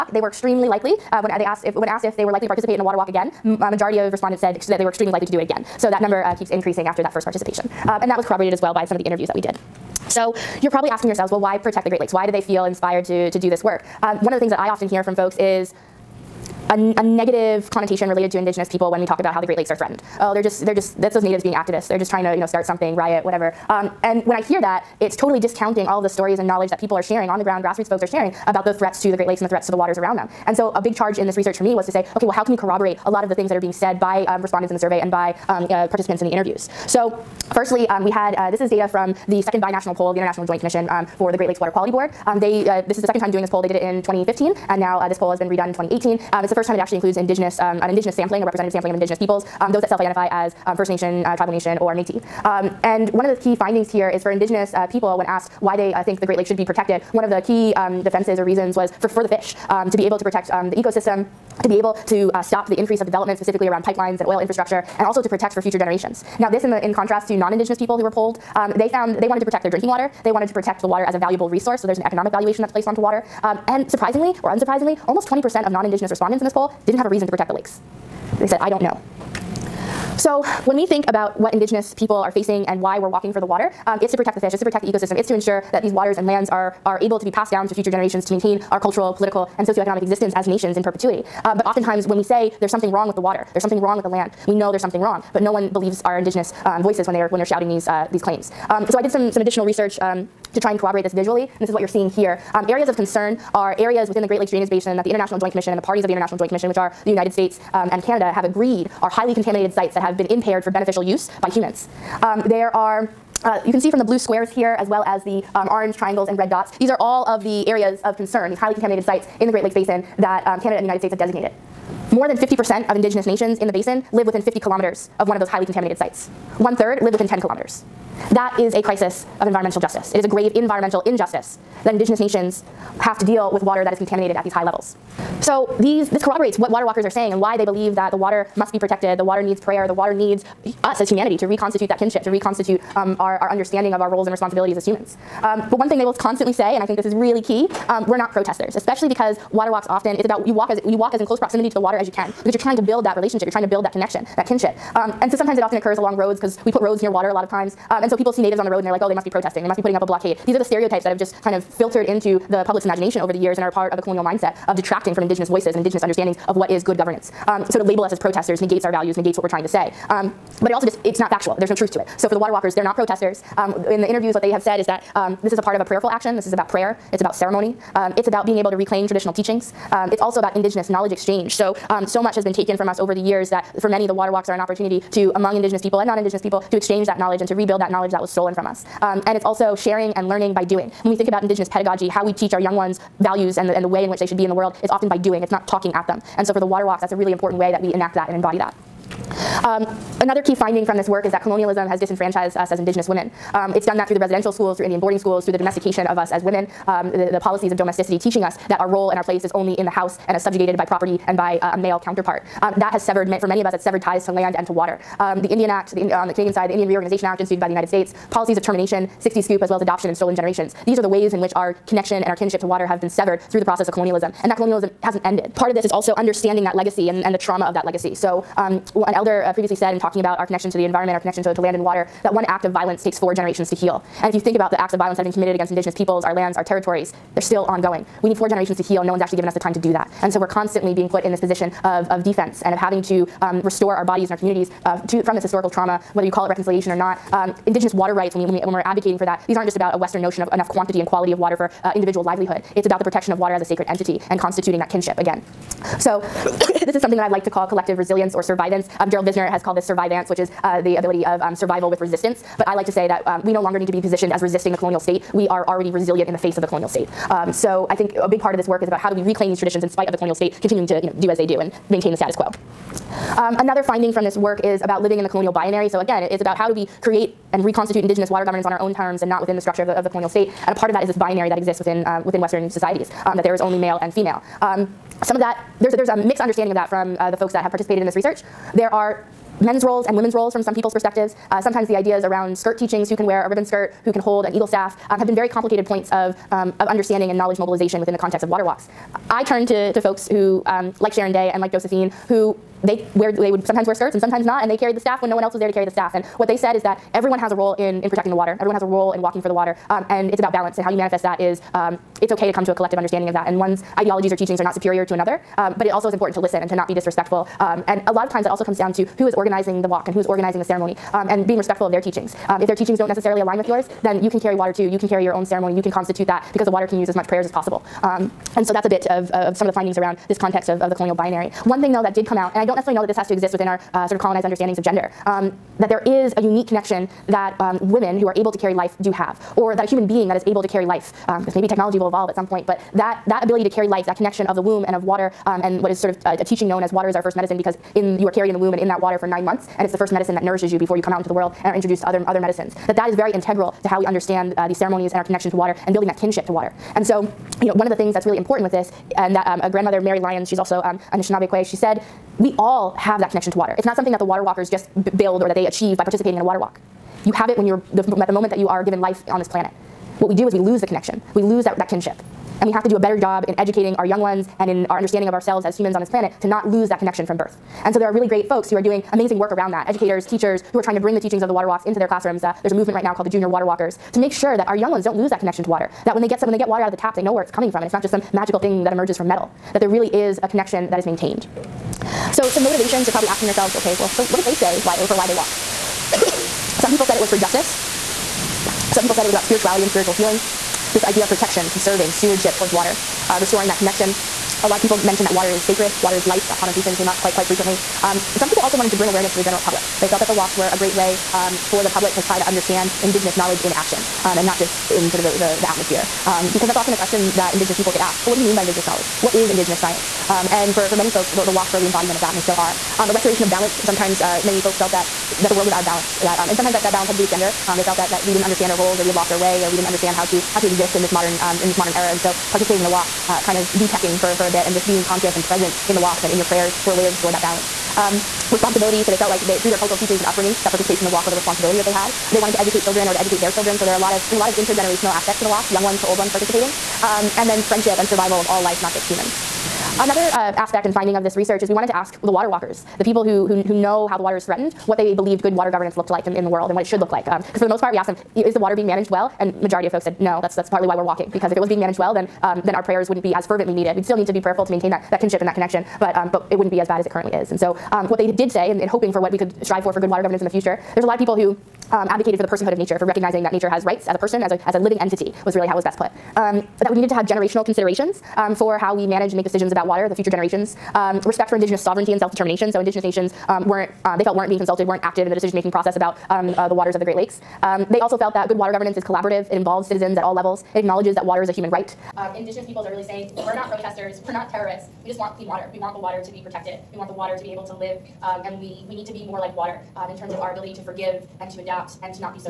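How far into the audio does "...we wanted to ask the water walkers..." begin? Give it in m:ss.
7:31.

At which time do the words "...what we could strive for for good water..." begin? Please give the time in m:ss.
7:49.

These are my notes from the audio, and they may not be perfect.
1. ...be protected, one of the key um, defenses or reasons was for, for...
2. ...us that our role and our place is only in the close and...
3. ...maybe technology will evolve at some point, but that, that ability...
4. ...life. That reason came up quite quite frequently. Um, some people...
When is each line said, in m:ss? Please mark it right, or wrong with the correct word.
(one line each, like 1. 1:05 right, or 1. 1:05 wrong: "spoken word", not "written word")
1. 0:56 right
2. 3:28 wrong: "house", not "close"
3. 5:41 right
4. 6:46 wrong: "connotation", not "reason".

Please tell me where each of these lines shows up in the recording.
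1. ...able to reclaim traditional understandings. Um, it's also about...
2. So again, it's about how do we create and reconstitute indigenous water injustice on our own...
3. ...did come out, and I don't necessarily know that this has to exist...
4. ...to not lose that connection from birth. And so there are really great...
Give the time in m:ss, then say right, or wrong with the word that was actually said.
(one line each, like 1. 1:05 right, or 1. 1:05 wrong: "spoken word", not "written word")
1. 2:58 wrong: "teachings", not "understandings"
2. 4:35 wrong: "governance", not "injustice"
3. 5:32 right
4. 6:16 right.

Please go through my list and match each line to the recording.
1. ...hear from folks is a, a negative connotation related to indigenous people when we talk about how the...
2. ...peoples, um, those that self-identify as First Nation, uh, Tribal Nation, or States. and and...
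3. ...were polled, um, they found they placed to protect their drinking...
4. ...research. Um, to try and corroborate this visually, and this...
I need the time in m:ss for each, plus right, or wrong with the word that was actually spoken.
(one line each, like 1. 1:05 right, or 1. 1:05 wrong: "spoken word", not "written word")
1. 0:14 right
2. 0:49 wrong: "Métis", not "States"
3. 1:08 wrong: "wanted", not "placed"
4. 1:39 right.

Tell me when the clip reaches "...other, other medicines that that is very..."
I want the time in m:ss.
5:52.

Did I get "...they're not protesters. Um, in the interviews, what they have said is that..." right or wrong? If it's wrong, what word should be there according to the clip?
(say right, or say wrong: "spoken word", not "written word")
right.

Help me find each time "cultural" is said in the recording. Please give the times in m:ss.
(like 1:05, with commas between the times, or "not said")
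1:28, 7:19.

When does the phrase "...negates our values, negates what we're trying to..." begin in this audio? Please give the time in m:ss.
2:48.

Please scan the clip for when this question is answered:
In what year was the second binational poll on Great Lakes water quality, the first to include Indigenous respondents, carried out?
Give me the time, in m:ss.
0:45.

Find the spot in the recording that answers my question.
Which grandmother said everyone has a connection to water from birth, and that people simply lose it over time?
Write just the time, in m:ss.
5:59.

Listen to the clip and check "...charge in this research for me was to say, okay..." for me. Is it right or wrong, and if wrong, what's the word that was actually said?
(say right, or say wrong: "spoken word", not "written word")
right.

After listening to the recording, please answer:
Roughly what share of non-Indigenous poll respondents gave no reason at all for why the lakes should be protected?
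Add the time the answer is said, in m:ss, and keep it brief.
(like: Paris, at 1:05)
20%, at 1:15.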